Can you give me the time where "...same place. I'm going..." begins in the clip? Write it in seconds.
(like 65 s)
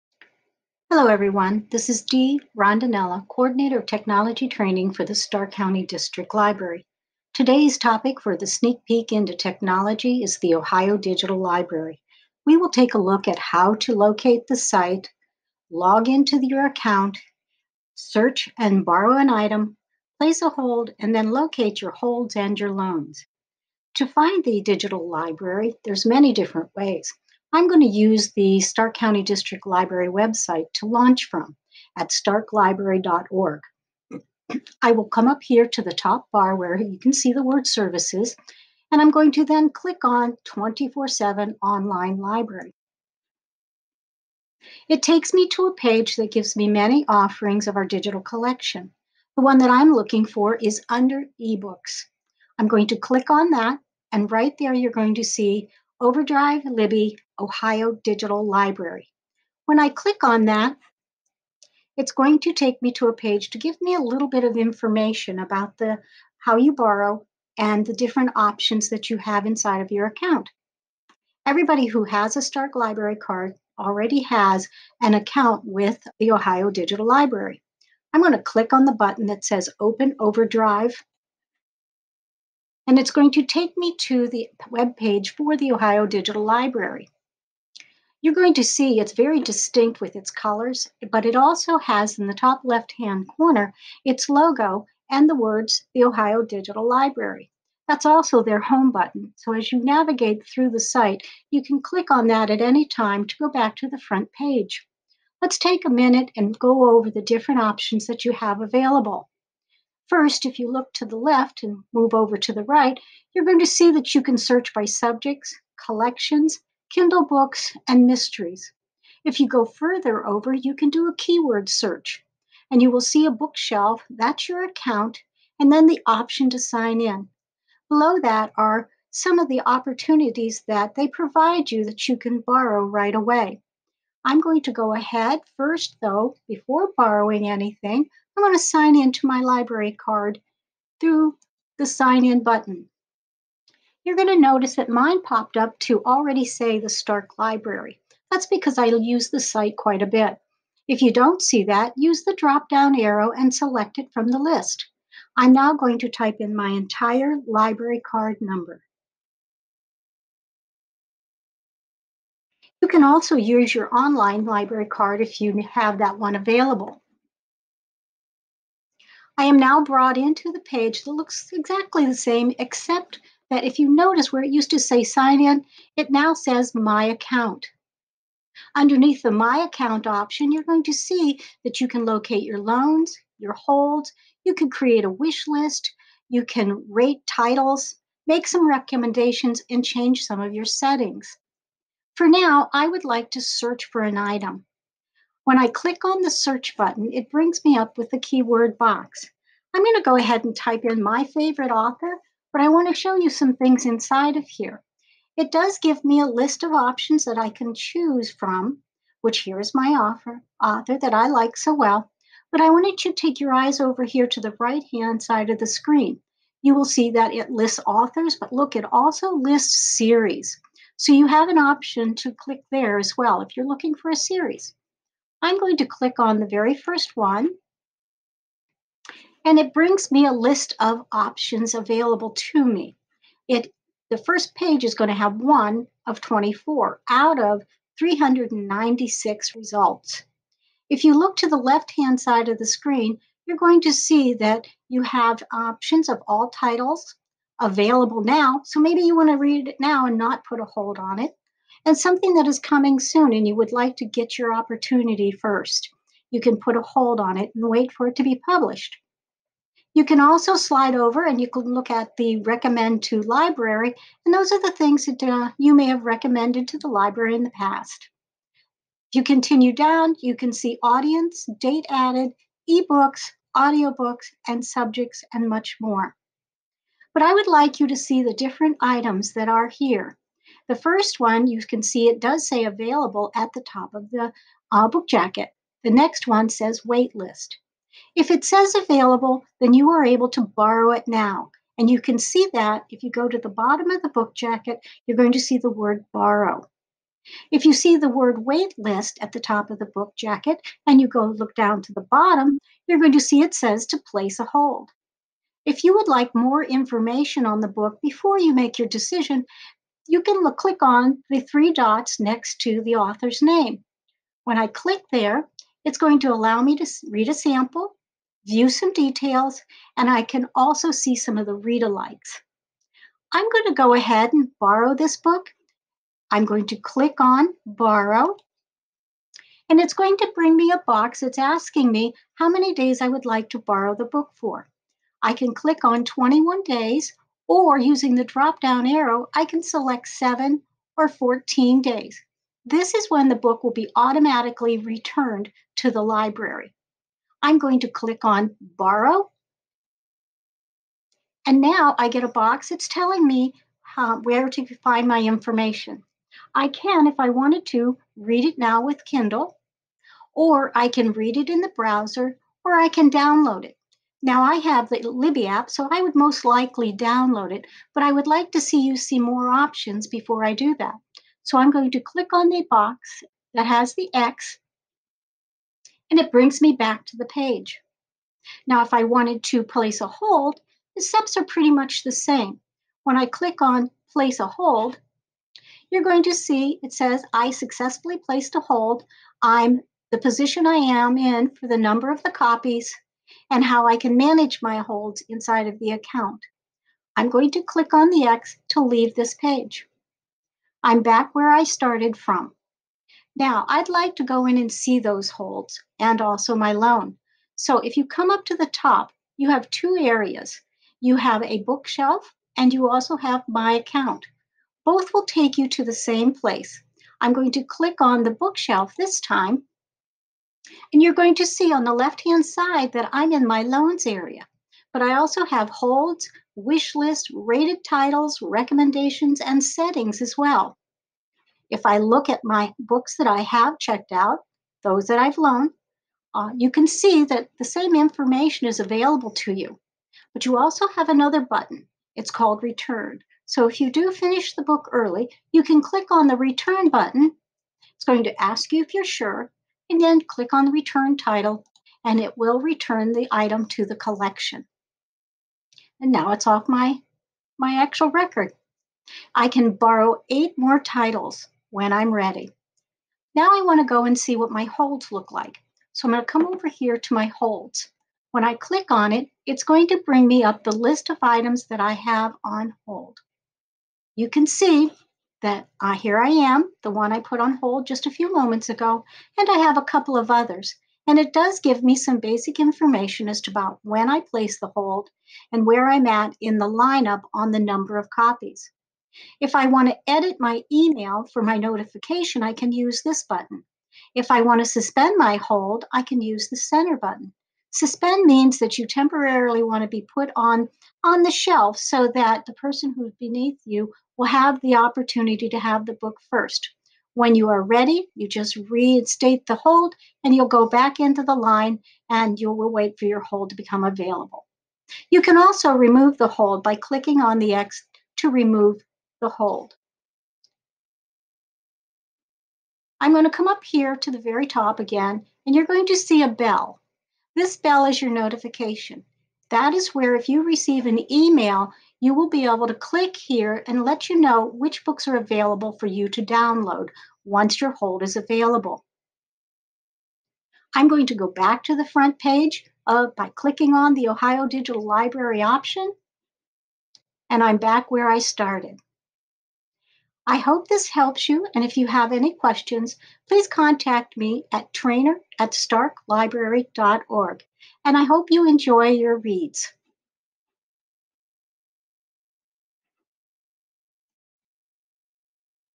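415 s.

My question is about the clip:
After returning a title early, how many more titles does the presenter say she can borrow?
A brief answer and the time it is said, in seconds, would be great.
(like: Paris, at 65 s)
8, at 460 s.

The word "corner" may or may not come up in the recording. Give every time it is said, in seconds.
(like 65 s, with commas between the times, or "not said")
93 s.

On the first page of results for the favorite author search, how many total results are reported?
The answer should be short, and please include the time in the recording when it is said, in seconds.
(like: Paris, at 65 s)
396, at 237 s.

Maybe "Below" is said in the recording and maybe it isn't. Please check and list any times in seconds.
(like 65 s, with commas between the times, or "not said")
127 s.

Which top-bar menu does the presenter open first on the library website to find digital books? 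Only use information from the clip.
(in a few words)
Services.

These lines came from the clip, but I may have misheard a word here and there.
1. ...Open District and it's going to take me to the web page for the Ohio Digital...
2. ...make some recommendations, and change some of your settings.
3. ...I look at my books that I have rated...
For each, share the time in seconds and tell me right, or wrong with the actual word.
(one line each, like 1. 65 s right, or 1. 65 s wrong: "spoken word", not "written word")
1. 79 s wrong: "Overdrive", not "District"
2. 188 s right
3. 431 s wrong: "checked", not "rated".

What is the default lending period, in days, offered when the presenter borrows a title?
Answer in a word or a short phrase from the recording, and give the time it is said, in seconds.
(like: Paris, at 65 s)
21 days, at 336 s.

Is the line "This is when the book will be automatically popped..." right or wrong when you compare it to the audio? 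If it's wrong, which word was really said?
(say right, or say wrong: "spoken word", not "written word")
wrong: "returned", not "popped".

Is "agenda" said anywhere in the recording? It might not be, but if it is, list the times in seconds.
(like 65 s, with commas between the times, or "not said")
not said.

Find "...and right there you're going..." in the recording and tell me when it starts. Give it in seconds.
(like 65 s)
54 s.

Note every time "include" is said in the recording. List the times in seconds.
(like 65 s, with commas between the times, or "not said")
not said.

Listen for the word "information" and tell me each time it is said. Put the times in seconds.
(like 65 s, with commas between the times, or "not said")
64 s, 306 s, 355 s, 437 s, 482 s.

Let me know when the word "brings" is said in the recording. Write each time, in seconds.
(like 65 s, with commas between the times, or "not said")
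197 s, 229 s, 330 s, 376 s, 470 s.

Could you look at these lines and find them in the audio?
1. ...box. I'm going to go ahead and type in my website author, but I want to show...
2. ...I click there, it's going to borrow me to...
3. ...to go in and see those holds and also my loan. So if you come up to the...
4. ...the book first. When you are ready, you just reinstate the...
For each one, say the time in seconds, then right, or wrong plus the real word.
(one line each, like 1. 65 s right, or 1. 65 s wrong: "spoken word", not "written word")
1. 198 s wrong: "favorite", not "website"
2. 314 s wrong: "allow", not "borrow"
3. 404 s right
4. 505 s right.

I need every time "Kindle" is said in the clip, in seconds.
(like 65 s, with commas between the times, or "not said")
116 s, 359 s.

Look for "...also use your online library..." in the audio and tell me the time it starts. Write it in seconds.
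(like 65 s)
163 s.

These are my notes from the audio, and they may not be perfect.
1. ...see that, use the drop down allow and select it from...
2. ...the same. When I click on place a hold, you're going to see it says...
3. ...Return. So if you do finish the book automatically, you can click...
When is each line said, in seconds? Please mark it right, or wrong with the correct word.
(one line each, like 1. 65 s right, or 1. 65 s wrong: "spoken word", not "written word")
1. 151 s wrong: "arrow", not "allow"
2. 382 s right
3. 442 s wrong: "early", not "automatically".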